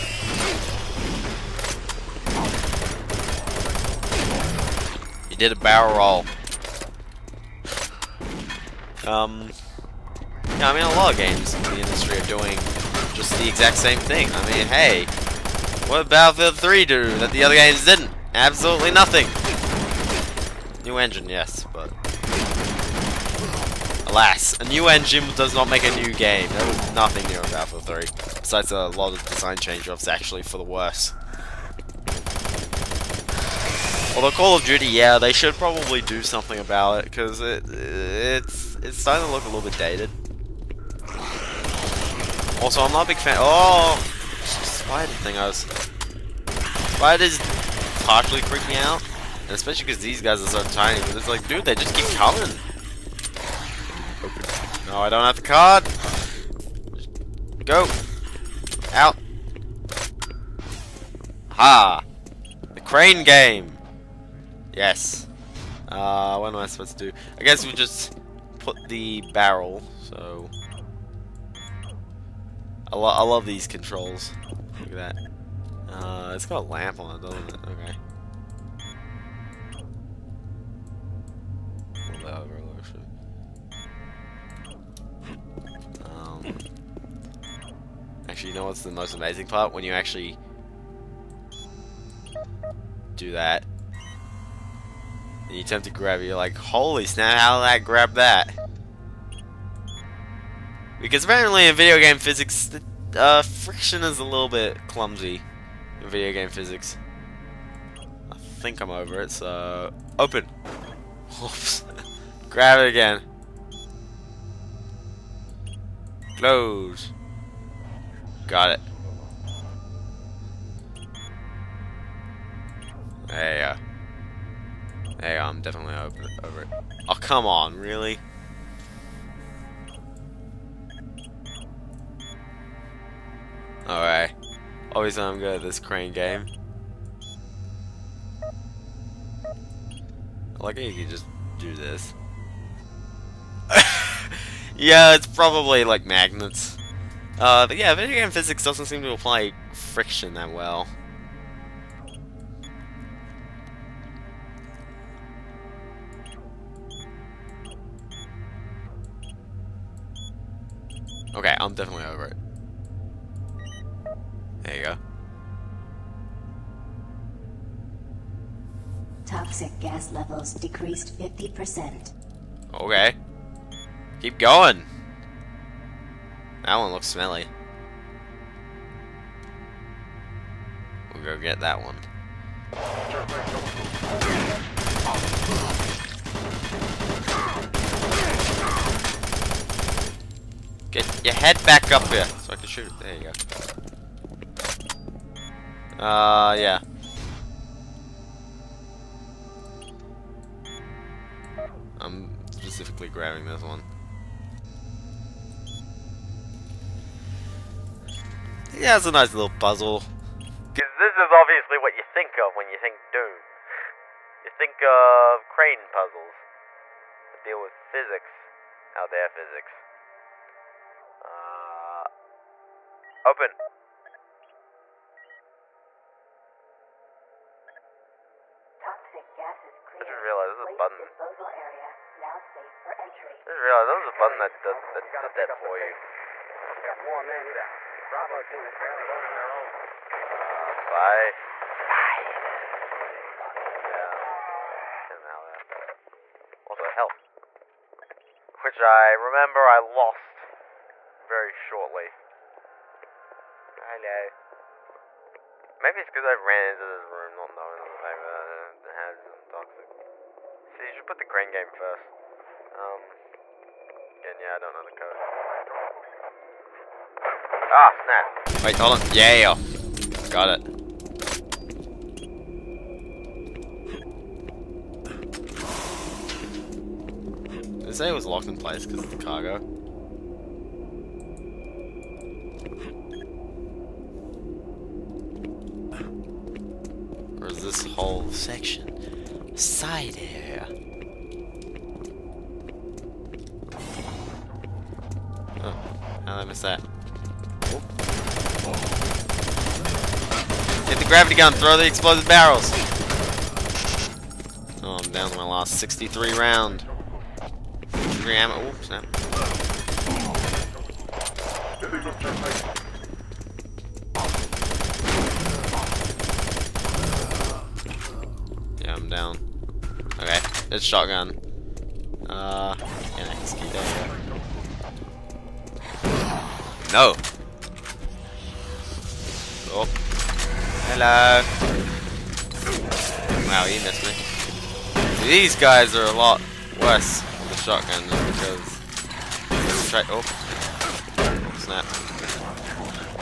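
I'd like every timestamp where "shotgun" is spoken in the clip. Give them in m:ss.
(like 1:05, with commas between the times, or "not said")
5:20, 5:37.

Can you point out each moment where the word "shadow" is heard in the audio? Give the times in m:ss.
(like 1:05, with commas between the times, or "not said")
not said.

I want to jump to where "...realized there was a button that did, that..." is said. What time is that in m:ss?
3:53.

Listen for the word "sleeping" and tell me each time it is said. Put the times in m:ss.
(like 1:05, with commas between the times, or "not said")
not said.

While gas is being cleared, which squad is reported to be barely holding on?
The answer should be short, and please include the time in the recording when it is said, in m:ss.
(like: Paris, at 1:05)
Bravo team, at 3:58.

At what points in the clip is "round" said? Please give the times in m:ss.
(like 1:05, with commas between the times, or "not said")
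5:06.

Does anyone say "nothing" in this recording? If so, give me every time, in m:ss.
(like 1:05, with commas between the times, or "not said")
0:18, 0:26.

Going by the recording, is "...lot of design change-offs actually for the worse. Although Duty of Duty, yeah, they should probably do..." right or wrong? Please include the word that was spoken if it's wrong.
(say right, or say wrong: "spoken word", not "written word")
wrong: "Call", not "Duty".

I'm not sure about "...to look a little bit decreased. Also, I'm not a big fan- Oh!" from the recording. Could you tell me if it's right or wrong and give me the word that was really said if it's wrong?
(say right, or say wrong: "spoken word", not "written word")
wrong: "dated", not "decreased".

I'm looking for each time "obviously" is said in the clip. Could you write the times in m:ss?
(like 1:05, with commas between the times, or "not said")
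2:14, 3:31.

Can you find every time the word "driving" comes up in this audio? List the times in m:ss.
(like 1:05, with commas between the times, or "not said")
not said.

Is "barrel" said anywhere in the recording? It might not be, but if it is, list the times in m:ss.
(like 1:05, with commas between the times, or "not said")
0:05, 1:09, 5:02.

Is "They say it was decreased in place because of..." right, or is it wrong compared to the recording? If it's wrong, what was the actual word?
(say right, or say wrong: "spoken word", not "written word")
wrong: "locked", not "decreased".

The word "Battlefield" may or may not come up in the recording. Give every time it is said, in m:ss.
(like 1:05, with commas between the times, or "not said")
0:16, 0:27.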